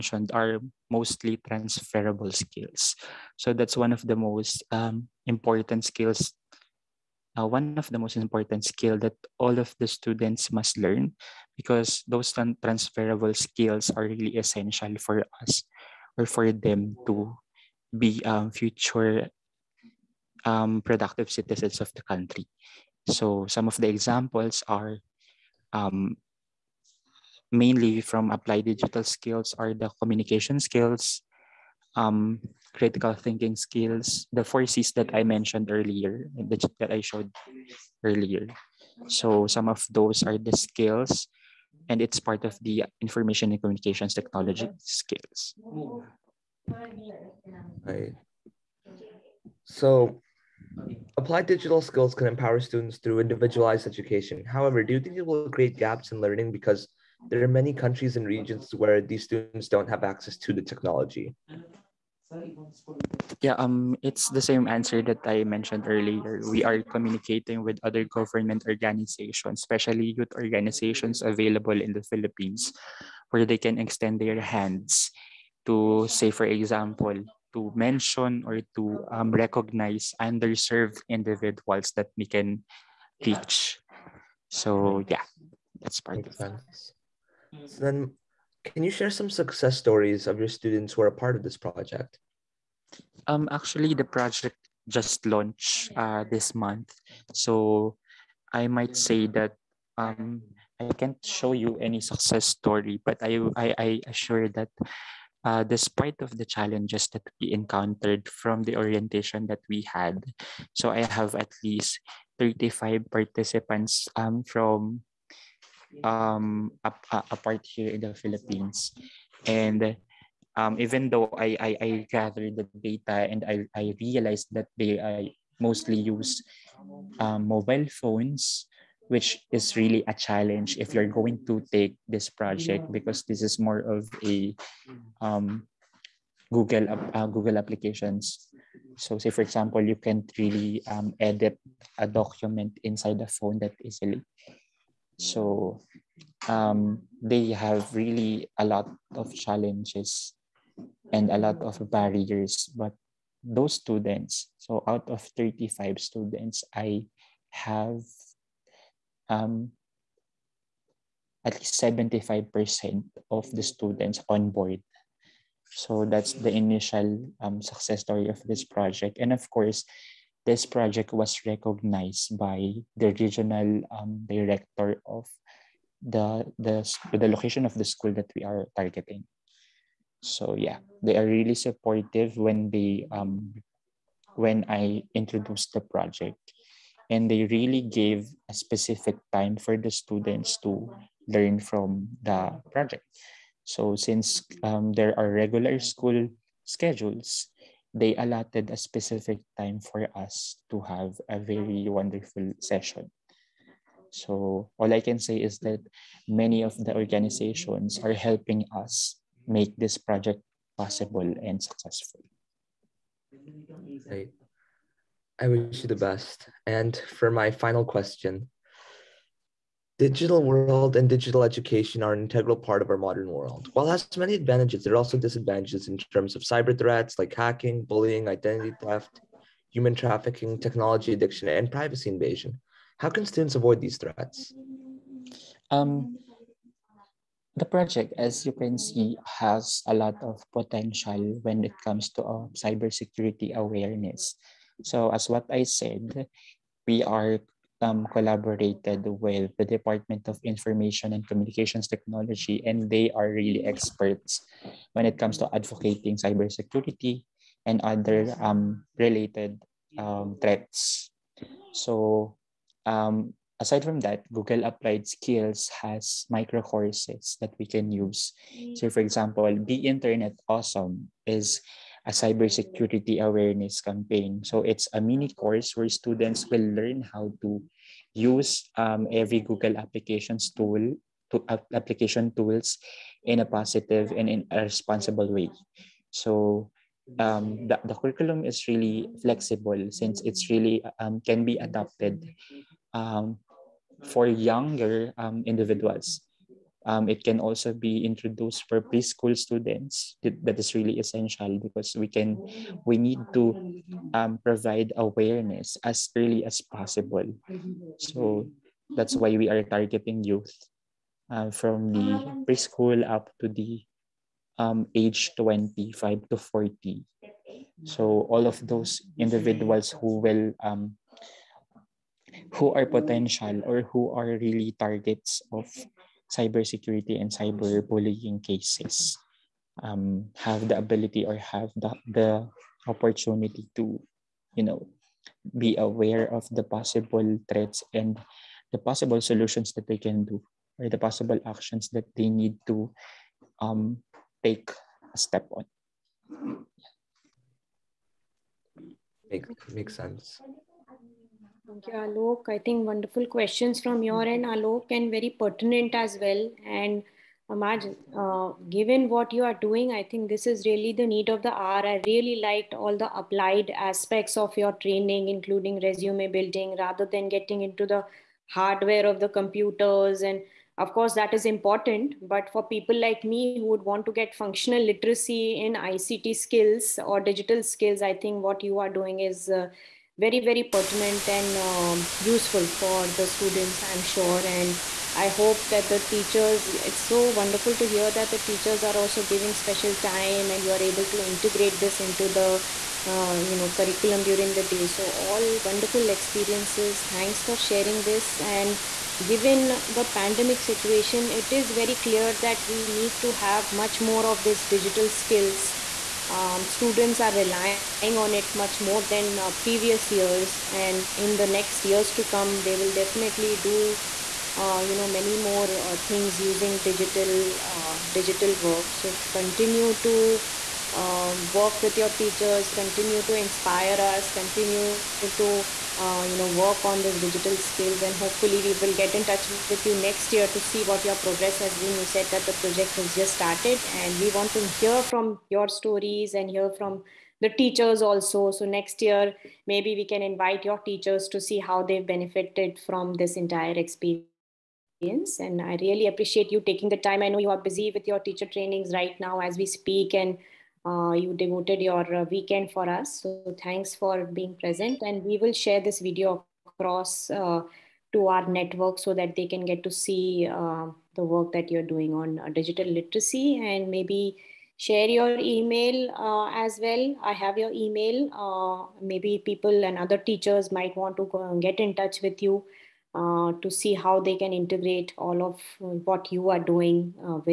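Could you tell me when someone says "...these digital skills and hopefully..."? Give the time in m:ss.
7:07.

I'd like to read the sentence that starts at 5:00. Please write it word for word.
That is really essential because we can, we need to um, provide awareness as early as possible.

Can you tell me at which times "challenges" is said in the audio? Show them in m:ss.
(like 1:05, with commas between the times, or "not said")
1:46, 2:10, 2:29.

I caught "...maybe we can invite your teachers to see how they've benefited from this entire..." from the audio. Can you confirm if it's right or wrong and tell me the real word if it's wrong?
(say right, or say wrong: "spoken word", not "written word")
right.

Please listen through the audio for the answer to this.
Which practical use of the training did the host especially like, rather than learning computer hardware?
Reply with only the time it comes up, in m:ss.
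6:05.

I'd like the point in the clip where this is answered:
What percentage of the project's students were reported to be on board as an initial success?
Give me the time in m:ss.
2:41.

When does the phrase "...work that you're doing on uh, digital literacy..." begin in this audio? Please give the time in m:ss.
7:41.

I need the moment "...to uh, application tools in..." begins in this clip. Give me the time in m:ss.
4:41.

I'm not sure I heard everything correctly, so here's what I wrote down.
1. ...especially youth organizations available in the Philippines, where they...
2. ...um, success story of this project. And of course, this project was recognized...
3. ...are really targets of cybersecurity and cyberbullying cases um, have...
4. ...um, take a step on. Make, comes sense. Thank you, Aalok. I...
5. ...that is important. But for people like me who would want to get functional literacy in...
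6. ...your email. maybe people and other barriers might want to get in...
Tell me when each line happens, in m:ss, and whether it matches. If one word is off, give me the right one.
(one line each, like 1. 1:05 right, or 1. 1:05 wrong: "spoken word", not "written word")
1. 1:09 right
2. 2:47 right
3. 5:24 right
4. 5:43 wrong: "makes", not "comes"
5. 6:11 right
6. 7:47 wrong: "teachers", not "barriers".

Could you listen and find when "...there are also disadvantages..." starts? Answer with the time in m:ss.
3:44.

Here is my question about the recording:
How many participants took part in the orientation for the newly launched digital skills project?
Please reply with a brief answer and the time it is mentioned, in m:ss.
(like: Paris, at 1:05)
35, at 1:52.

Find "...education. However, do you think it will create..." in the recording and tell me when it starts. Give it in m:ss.
0:53.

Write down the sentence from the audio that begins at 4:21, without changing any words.
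So um, aside from that, Google Applied Skills has micro courses that we can use.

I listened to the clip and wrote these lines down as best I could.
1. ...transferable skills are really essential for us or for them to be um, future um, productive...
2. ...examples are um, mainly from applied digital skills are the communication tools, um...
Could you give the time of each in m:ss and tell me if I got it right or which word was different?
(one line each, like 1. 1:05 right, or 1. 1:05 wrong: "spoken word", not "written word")
1. 0:12 right
2. 0:23 wrong: "skills", not "tools".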